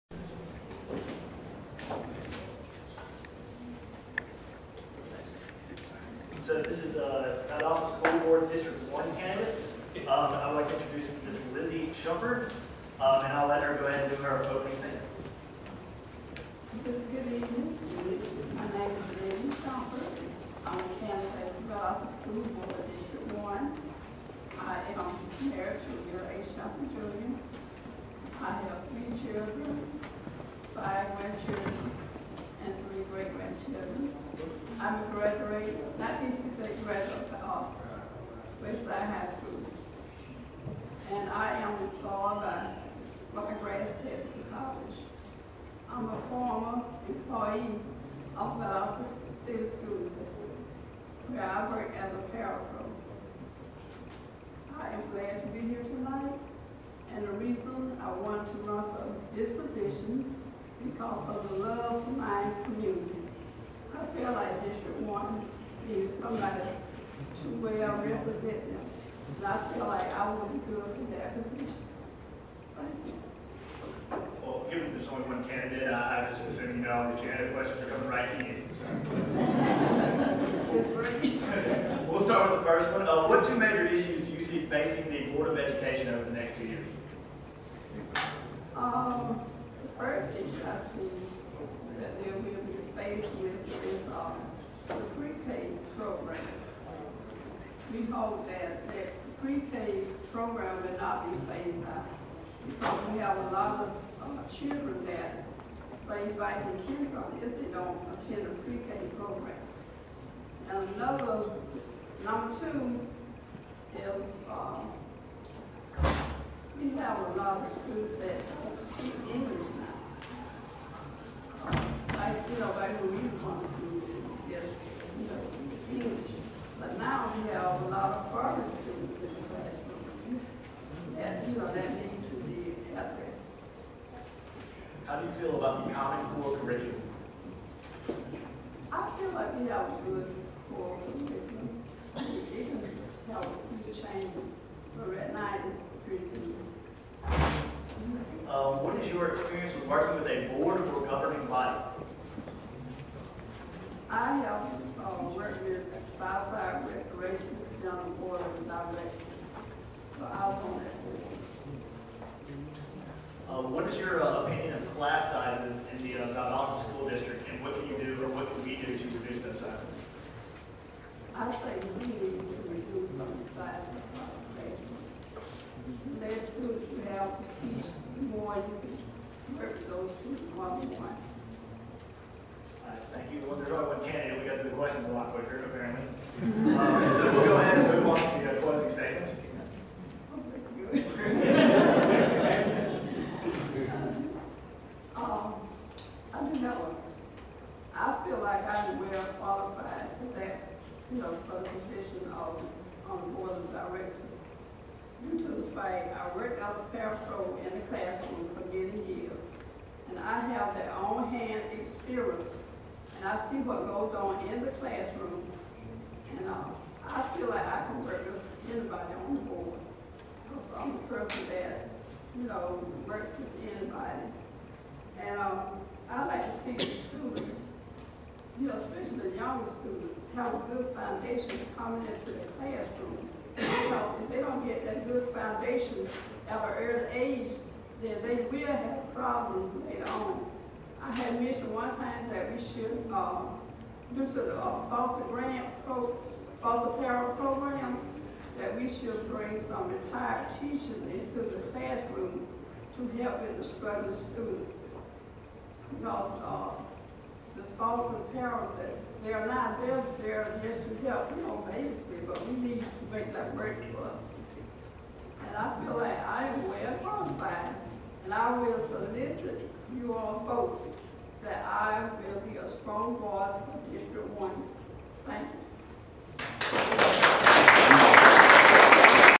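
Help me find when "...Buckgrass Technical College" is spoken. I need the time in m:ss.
0:43.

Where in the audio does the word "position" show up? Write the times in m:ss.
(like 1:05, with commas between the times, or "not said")
1:11, 3:21.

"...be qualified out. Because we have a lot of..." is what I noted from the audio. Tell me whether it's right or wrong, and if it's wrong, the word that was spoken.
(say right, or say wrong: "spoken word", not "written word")
wrong: "phased", not "qualified".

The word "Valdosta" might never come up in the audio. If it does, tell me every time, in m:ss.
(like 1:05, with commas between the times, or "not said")
0:07, 0:21, 2:46.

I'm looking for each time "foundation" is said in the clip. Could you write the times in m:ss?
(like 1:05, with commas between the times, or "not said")
3:50, 3:55.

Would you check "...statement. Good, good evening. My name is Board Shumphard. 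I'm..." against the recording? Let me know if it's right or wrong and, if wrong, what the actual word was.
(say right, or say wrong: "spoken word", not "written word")
wrong: "Lizzie", not "Board".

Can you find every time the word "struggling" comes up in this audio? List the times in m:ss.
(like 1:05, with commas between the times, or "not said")
4:13.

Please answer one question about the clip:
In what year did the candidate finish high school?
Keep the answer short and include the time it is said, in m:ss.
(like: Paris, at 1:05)
1968, at 0:35.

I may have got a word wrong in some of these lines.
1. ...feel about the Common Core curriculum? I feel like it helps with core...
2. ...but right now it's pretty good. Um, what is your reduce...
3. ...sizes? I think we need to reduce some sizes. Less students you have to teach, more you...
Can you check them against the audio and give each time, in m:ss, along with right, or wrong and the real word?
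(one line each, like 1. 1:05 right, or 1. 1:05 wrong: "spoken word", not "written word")
1. 2:15 right
2. 2:24 wrong: "experience", not "reduce"
3. 2:49 right.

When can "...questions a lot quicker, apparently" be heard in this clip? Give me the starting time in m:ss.
3:04.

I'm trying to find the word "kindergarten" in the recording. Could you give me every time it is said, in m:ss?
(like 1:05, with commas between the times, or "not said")
1:46.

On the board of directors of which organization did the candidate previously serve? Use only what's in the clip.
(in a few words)
Southside Recreation.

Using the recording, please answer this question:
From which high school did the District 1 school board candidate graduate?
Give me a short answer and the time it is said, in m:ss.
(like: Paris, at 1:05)
Westside High School, at 0:38.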